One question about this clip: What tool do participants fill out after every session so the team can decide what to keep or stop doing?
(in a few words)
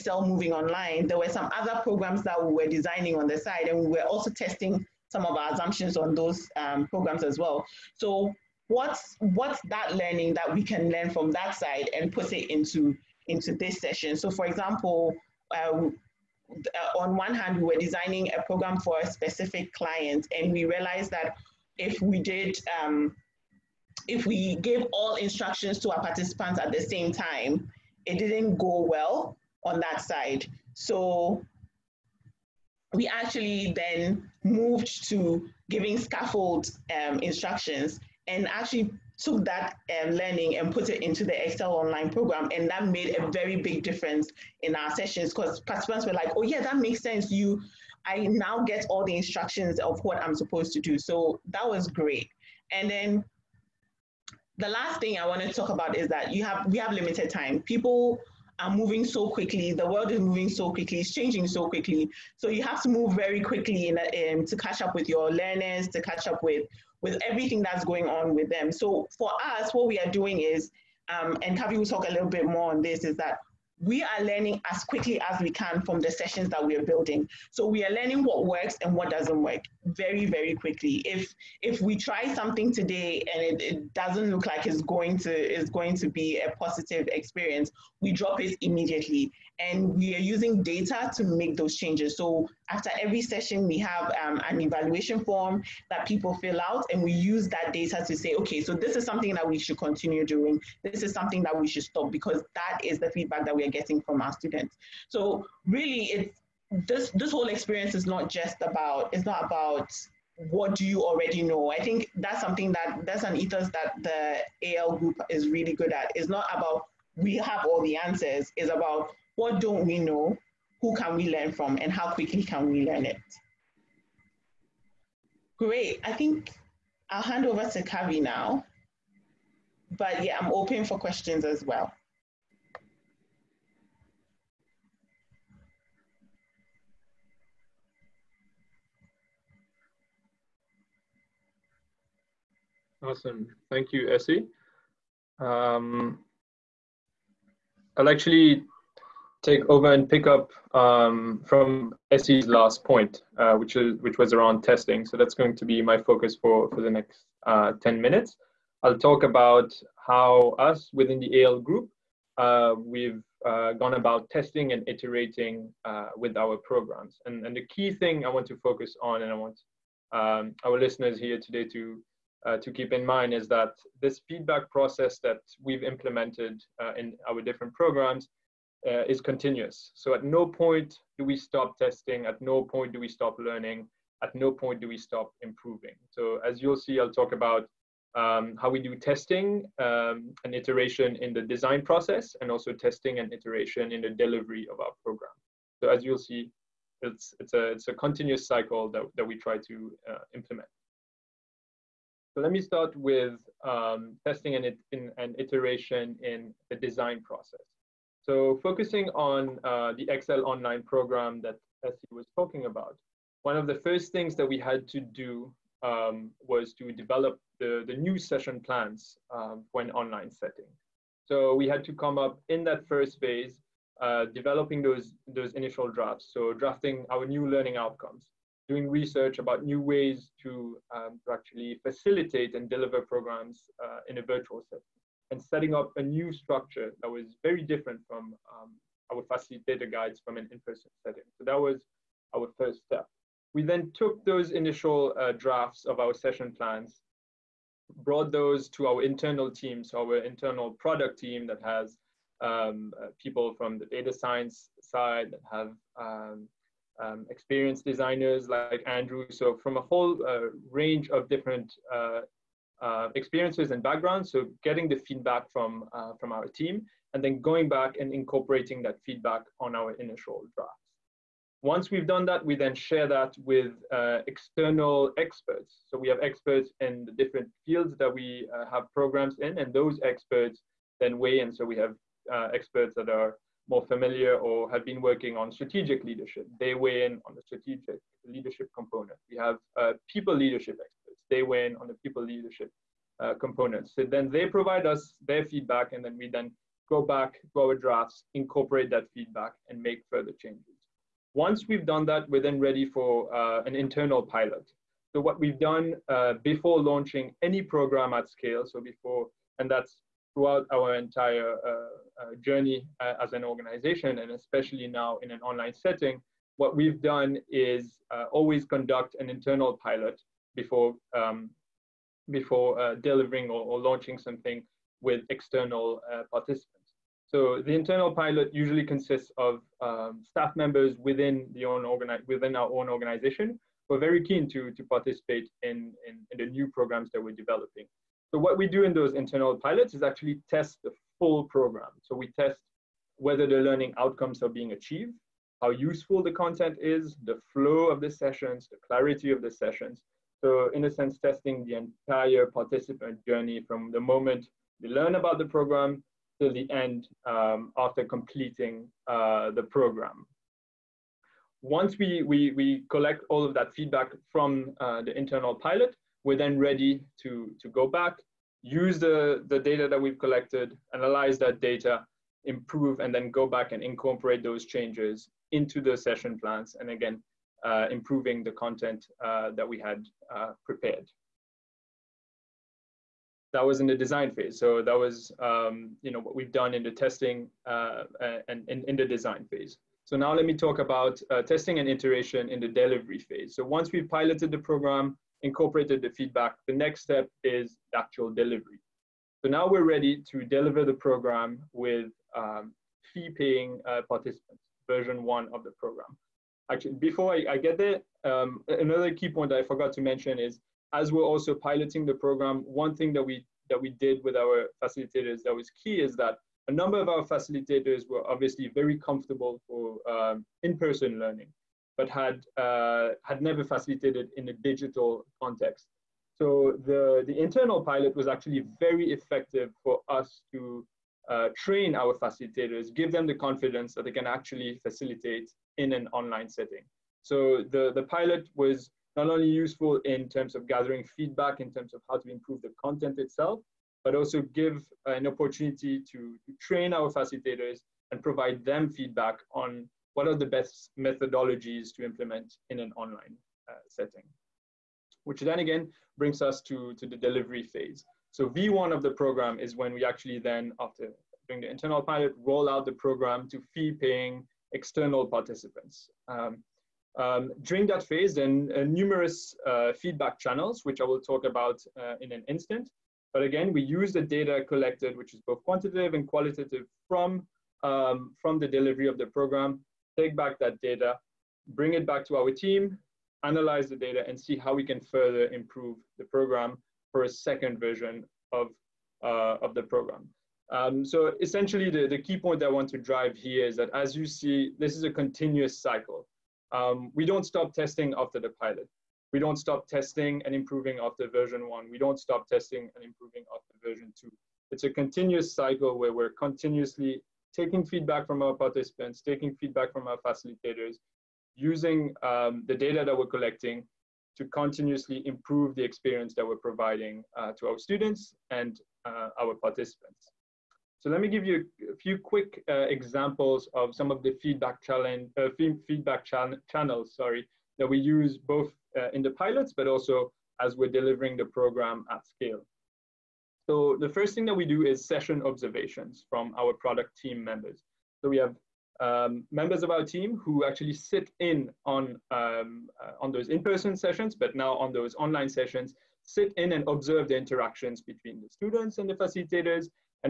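evaluation form.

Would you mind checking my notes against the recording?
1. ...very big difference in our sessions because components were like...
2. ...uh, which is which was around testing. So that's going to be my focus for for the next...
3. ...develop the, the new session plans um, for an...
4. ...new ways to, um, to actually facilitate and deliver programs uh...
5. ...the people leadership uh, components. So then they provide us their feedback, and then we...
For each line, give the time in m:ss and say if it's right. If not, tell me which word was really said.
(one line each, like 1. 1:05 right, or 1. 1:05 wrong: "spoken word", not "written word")
1. 0:43 wrong: "participants", not "components"
2. 2:33 right
3. 3:36 right
4. 3:49 right
5. 4:51 right.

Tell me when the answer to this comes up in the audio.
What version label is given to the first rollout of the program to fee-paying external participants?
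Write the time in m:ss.
7:38.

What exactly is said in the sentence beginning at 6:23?
That was in the design phase.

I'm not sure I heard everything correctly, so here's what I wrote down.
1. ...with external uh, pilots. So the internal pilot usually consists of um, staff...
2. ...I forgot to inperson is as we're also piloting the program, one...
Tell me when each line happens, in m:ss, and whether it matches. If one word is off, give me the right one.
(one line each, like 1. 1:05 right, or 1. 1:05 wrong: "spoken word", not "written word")
1. 5:25 wrong: "participants", not "pilots"
2. 6:49 wrong: "mention", not "inperson".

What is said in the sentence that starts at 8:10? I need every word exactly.
Um, so essentially, the, the key point I want to drive here is that as you see, this is a continuous cycle.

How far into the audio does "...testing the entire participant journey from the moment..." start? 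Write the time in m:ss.
5:51.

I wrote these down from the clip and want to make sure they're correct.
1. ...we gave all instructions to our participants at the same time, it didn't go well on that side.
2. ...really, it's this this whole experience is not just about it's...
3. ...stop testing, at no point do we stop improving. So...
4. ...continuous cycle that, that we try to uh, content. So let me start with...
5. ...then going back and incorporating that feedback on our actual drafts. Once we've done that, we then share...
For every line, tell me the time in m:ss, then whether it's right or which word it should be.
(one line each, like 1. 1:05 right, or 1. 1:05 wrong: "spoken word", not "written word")
1. 0:24 right
2. 1:45 right
3. 3:03 wrong: "learning", not "testing"
4. 3:17 wrong: "implement", not "content"
5. 4:27 wrong: "initial", not "actual".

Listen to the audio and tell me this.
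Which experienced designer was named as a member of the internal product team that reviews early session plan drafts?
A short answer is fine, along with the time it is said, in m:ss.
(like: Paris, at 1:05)
Andre, at 4:18.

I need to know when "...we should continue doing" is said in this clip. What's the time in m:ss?
1:39.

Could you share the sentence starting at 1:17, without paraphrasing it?
So we are learning what works and what doesn't work very, very quickly.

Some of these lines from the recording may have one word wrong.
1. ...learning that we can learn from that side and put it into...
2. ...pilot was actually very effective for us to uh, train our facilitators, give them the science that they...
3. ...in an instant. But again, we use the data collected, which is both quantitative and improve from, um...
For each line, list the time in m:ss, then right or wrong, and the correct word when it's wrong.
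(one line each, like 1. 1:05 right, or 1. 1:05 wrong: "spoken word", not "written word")
1. 0:09 right
2. 7:07 wrong: "confidence", not "science"
3. 7:52 wrong: "qualitative", not "improve".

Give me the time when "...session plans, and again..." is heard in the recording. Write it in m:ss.
6:15.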